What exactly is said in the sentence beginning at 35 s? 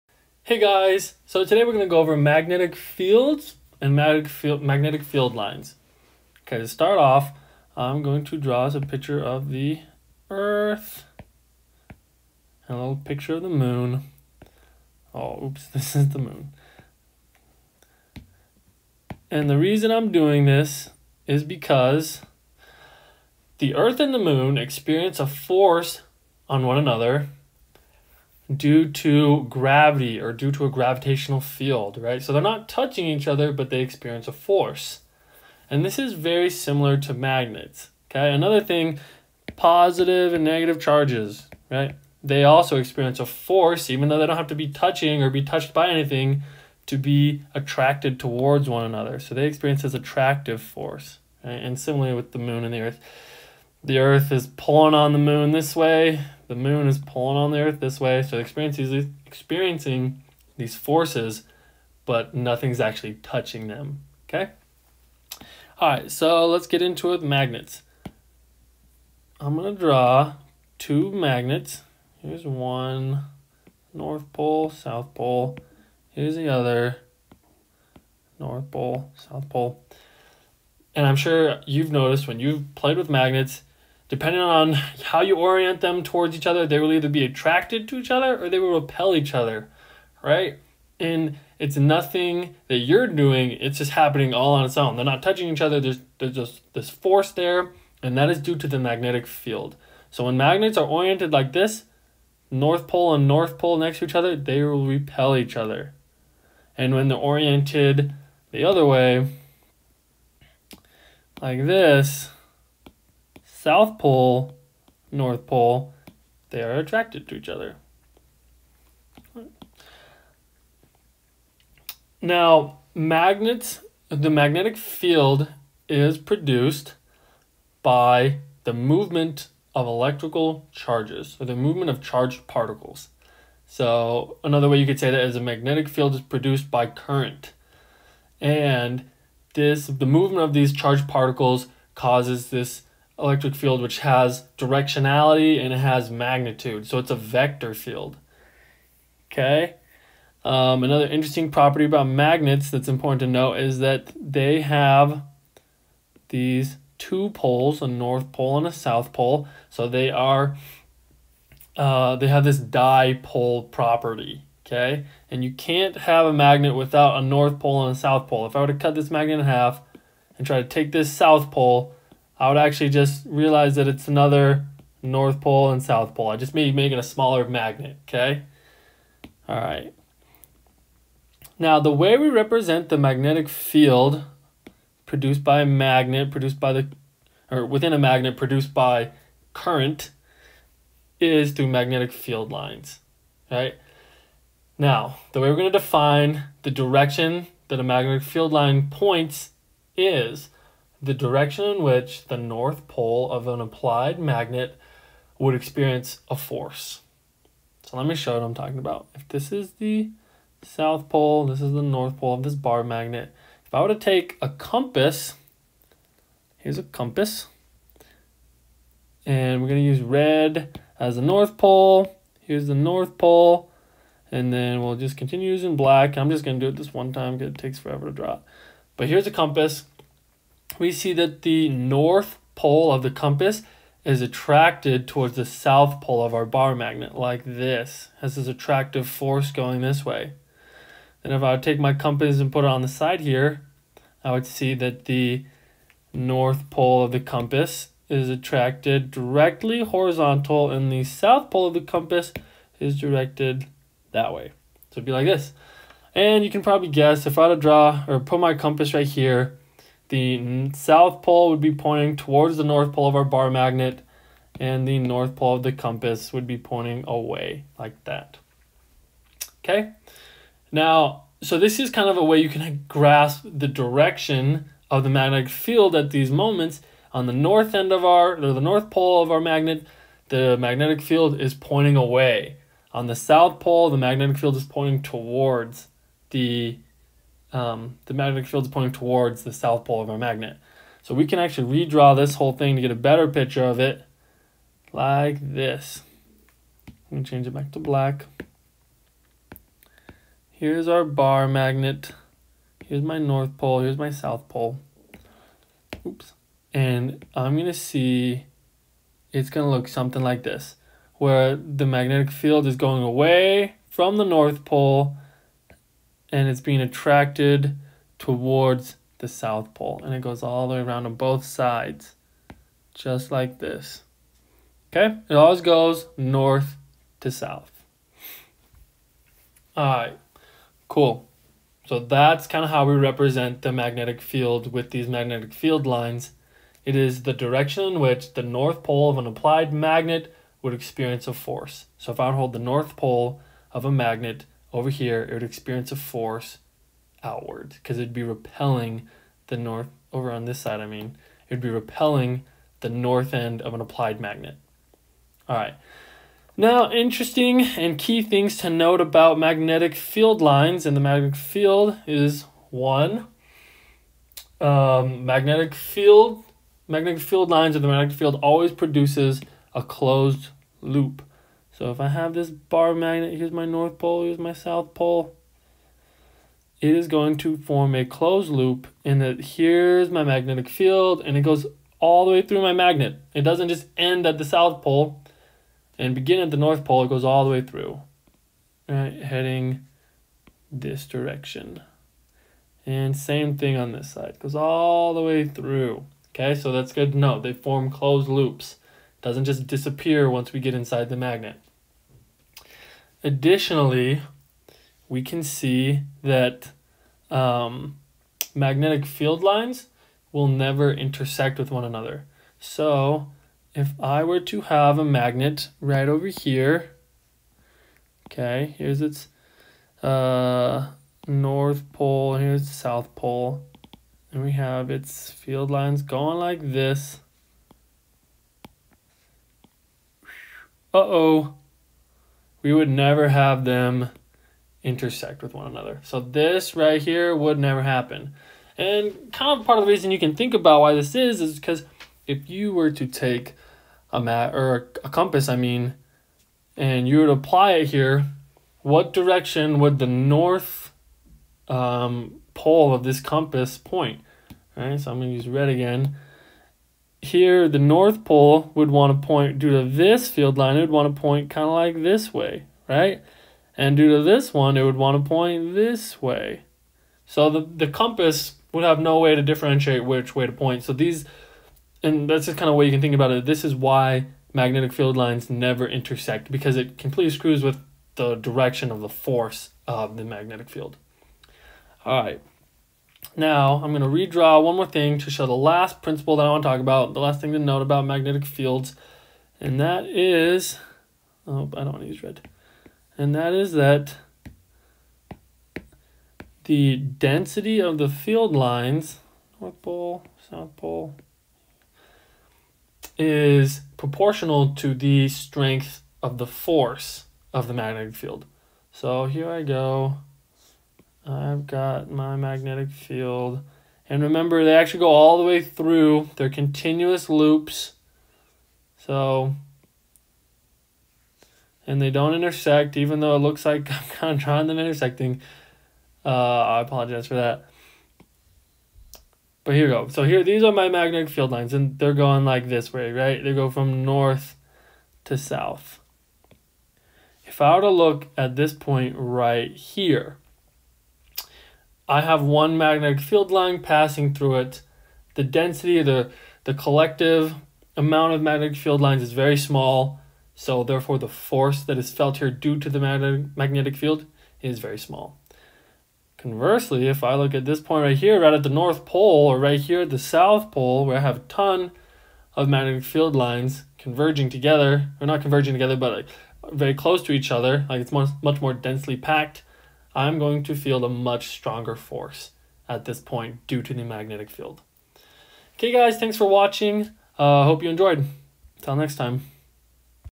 And this is very similar to magnets, okay?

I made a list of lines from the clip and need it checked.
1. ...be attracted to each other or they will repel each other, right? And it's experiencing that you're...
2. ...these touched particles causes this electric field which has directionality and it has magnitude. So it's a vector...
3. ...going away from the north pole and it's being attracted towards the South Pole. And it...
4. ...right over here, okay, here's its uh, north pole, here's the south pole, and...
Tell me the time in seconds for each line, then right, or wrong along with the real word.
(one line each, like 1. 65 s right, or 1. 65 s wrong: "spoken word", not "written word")
1. 87 s wrong: "nothing", not "experiencing"
2. 140 s wrong: "charged", not "touched"
3. 312 s right
4. 415 s right.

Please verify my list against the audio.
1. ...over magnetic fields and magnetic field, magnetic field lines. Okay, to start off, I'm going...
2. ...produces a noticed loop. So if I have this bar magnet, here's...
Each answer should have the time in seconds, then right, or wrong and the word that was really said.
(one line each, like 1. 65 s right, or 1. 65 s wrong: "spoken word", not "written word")
1. 2 s right
2. 368 s wrong: "closed", not "noticed".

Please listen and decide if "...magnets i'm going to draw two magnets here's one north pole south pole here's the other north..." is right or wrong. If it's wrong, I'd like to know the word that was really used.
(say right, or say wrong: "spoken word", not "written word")
right.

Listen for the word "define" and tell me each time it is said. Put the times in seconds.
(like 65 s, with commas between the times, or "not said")
195 s.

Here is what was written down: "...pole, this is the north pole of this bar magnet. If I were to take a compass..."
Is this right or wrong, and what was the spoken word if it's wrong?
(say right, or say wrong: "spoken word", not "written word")
right.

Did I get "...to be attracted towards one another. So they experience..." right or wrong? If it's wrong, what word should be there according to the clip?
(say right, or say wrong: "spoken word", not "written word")
right.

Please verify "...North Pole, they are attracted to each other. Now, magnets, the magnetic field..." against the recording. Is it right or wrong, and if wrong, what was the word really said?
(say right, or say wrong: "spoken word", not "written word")
right.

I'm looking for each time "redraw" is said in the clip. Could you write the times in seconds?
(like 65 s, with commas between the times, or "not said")
291 s, 484 s.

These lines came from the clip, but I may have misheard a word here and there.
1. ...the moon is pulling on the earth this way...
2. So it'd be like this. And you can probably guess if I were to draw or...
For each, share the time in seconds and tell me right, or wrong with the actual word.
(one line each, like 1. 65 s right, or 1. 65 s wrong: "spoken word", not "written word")
1. 56 s right
2. 254 s right.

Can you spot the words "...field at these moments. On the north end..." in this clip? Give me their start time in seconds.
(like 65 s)
275 s.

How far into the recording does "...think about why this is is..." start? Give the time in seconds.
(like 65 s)
440 s.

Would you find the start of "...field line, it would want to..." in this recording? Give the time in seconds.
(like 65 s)
460 s.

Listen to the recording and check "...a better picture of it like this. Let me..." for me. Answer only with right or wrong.
right.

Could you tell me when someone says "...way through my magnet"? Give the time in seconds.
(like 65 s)
382 s.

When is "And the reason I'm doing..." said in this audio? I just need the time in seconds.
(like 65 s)
19 s.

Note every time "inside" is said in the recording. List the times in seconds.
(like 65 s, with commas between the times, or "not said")
400 s.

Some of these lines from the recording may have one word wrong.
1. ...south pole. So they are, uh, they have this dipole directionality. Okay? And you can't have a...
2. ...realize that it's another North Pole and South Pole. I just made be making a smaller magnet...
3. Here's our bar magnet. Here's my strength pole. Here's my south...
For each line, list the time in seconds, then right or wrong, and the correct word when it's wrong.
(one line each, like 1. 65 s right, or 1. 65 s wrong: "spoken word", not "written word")
1. 158 s wrong: "property", not "directionality"
2. 173 s right
3. 300 s wrong: "north", not "strength".